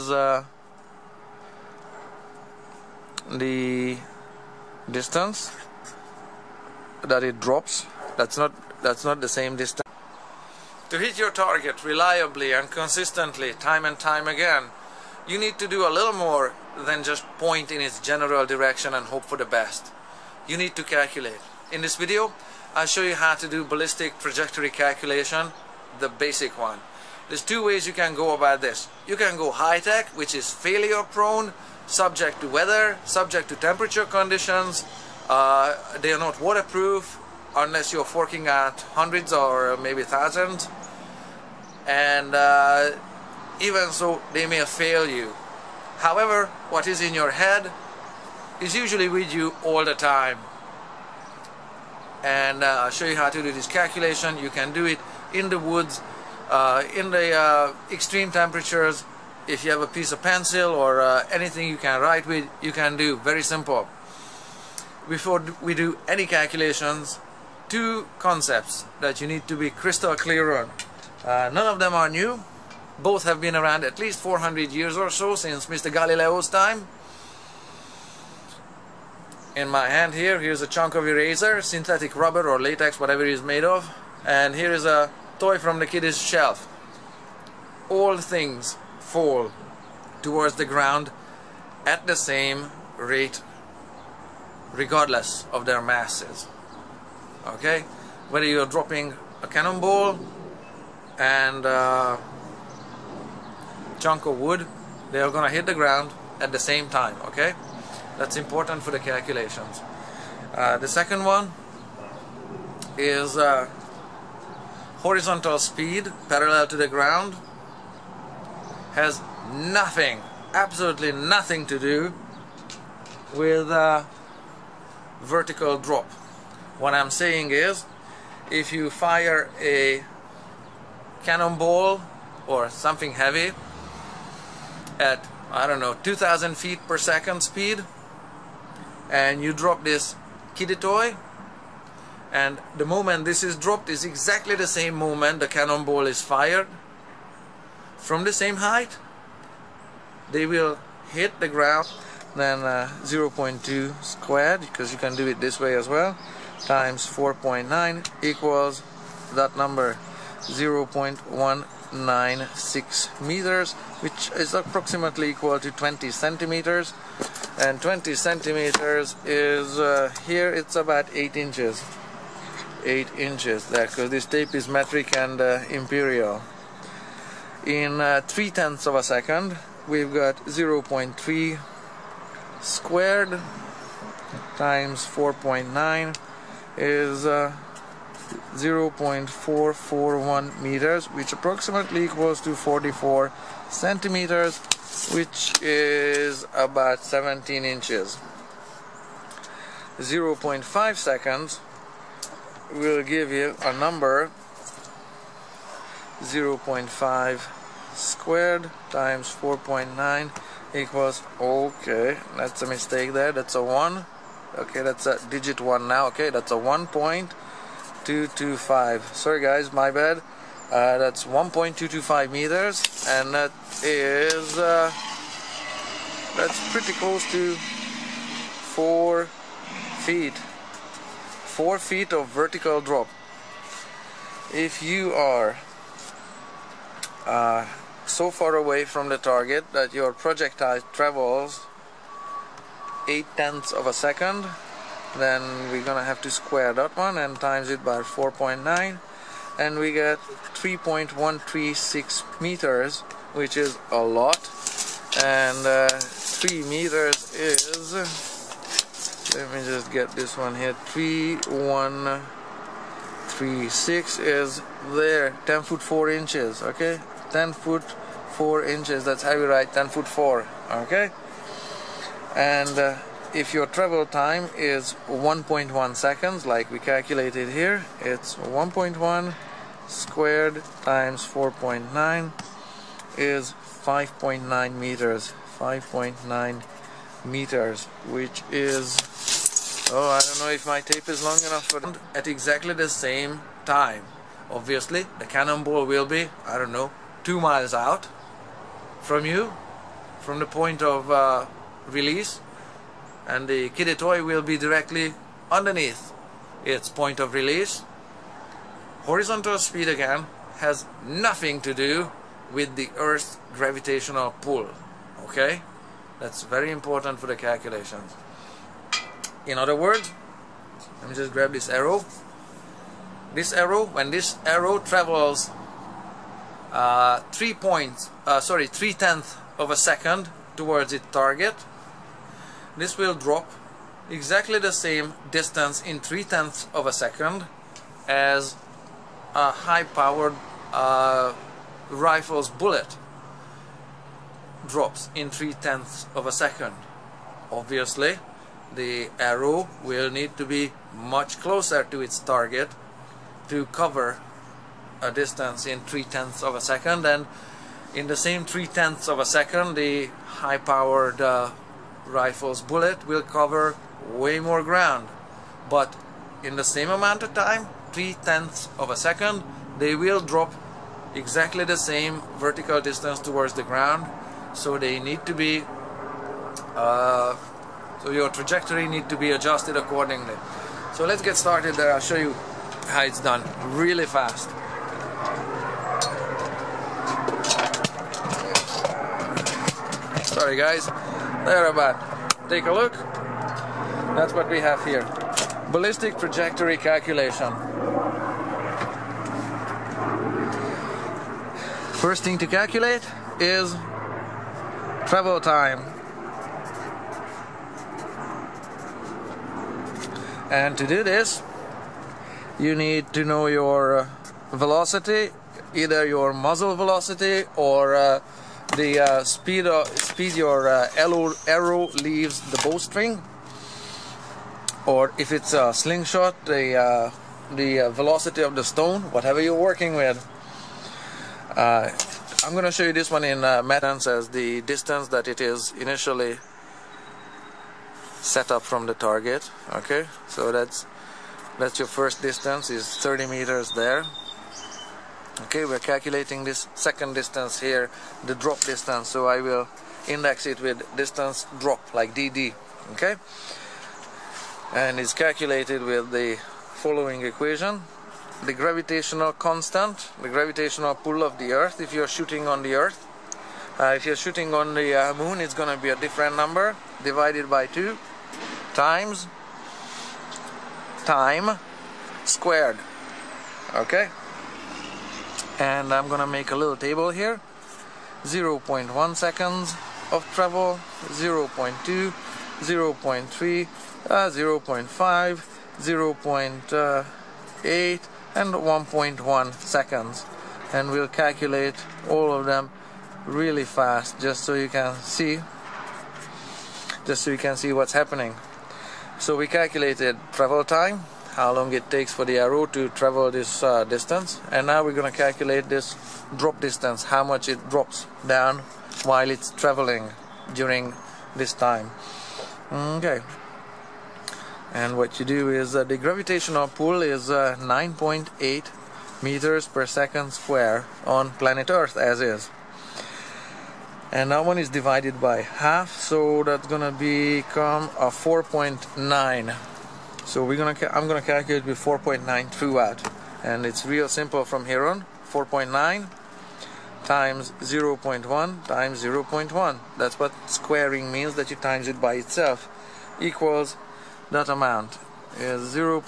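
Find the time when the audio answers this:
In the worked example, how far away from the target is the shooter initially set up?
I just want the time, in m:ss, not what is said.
7:22.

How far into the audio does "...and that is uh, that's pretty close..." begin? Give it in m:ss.
3:43.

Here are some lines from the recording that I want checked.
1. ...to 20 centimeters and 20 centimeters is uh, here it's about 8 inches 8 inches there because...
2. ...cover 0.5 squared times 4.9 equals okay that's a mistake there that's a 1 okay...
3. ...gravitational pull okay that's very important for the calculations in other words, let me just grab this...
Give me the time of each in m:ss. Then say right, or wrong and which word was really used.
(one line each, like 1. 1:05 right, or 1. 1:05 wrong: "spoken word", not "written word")
1. 2:45 right
2. 3:23 wrong: "number", not "cover"
3. 5:13 right.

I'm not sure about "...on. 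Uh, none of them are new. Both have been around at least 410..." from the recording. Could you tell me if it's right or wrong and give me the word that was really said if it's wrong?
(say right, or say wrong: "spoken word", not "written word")
wrong: "400", not "410".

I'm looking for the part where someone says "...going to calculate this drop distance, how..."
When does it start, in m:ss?
8:24.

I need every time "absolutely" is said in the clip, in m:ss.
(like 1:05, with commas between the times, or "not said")
2:00.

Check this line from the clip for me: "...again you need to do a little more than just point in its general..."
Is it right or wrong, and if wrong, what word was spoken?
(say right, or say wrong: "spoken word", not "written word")
right.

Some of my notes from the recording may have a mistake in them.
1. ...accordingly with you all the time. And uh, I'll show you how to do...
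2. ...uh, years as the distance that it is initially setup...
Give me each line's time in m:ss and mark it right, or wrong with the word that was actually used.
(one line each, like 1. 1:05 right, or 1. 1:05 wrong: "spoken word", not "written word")
1. 0:48 wrong: "usually", not "accordingly"
2. 7:13 wrong: "meters", not "years".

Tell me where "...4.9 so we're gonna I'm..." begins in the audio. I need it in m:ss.
8:48.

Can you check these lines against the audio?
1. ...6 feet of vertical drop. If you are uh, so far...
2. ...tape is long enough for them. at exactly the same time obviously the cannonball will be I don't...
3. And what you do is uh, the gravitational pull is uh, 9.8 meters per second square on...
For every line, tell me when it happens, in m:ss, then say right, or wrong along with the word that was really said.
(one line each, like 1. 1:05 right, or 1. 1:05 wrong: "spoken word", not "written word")
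1. 3:51 wrong: "4", not "6"
2. 4:50 right
3. 8:34 right.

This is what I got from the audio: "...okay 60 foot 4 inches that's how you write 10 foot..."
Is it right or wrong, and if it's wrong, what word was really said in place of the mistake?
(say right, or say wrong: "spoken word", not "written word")
wrong: "10", not "60".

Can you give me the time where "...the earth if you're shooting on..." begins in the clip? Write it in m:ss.
7:41.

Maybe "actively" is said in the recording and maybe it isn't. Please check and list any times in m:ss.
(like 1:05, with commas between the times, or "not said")
not said.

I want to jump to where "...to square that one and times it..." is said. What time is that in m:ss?
4:06.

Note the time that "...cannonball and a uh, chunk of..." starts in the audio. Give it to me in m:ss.
1:39.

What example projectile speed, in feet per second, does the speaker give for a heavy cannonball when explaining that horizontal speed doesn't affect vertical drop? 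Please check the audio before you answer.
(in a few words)
2,000 feet per second.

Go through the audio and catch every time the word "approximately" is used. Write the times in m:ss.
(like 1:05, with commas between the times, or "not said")
2:44, 3:11.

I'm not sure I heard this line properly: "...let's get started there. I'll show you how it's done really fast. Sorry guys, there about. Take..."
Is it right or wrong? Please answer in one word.
right.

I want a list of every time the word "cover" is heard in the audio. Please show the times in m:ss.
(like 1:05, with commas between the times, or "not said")
5:53, 6:03.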